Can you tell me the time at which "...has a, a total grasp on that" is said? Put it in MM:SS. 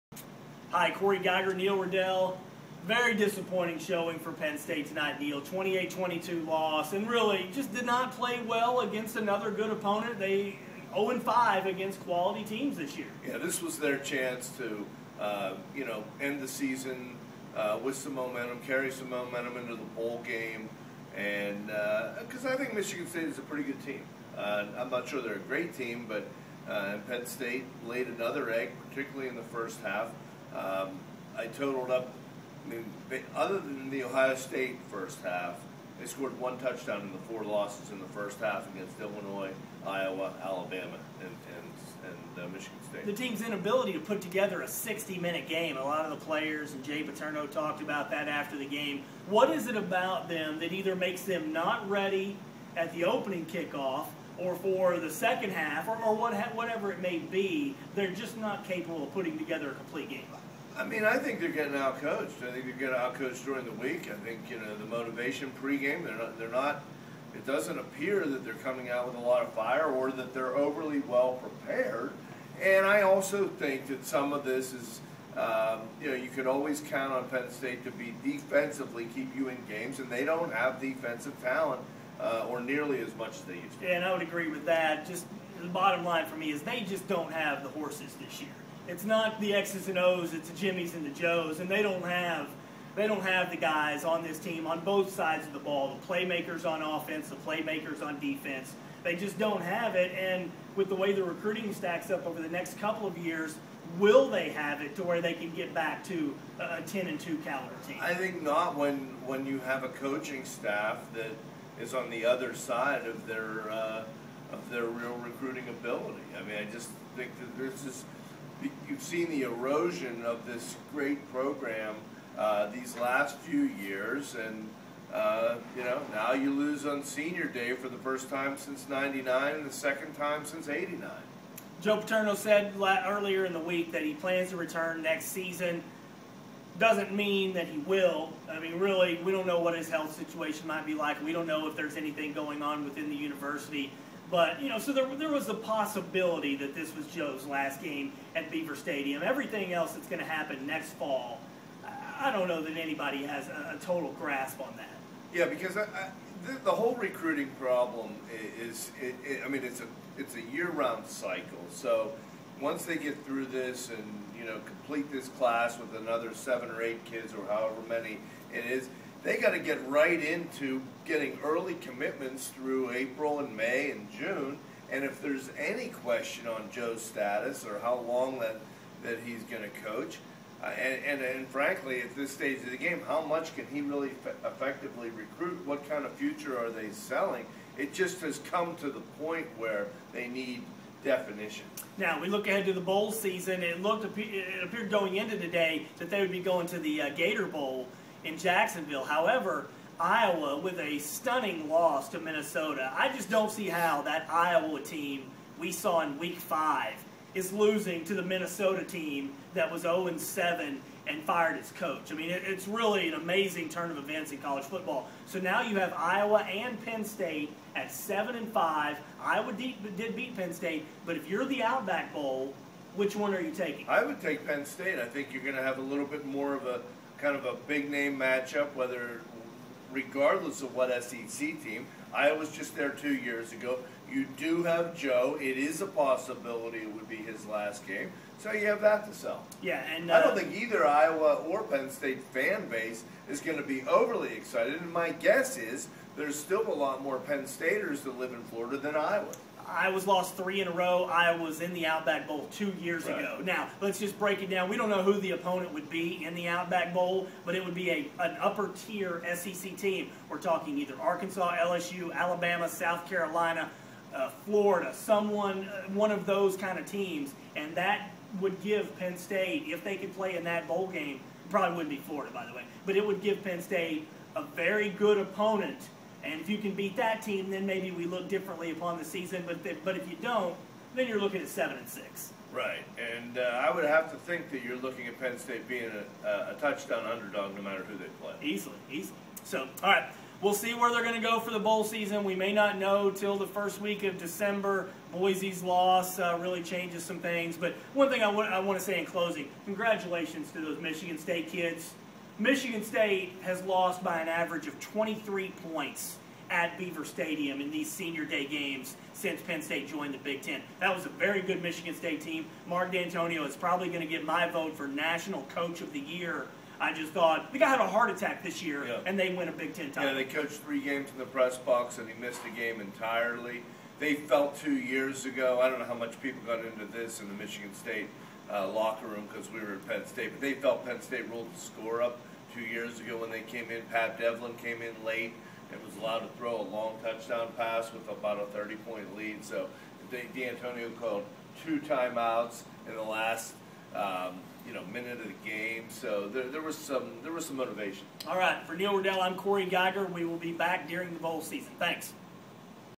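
02:33.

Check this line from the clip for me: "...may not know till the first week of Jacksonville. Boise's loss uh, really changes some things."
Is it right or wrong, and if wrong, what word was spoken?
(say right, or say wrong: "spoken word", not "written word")
wrong: "December", not "Jacksonville".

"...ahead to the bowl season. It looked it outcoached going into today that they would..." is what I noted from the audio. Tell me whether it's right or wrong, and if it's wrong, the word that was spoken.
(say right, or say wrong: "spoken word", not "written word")
wrong: "appeared", not "outcoached".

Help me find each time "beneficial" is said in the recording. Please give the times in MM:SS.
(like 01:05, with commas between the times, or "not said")
not said.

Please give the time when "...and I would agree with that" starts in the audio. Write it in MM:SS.
01:23.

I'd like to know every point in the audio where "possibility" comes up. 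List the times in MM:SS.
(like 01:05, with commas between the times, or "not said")
02:25, 03:55.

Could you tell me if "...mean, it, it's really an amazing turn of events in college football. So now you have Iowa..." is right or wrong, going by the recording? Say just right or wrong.
right.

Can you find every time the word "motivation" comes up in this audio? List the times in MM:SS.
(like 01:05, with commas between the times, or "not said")
01:04, 05:47.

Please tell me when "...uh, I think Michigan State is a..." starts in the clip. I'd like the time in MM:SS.
00:22.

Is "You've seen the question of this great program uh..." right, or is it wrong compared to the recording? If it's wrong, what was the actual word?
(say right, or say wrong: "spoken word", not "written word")
wrong: "erosion", not "question".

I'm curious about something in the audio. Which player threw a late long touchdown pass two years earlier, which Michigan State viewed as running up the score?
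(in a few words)
Pat Devlin.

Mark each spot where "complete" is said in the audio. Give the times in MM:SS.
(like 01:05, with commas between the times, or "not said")
00:59, 02:44.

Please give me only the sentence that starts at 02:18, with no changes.
I mean, really, we don't know what his health situation might be like.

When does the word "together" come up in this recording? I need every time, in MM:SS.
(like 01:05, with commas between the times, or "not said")
00:44, 00:59.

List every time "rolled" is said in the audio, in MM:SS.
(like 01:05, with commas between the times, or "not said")
05:31.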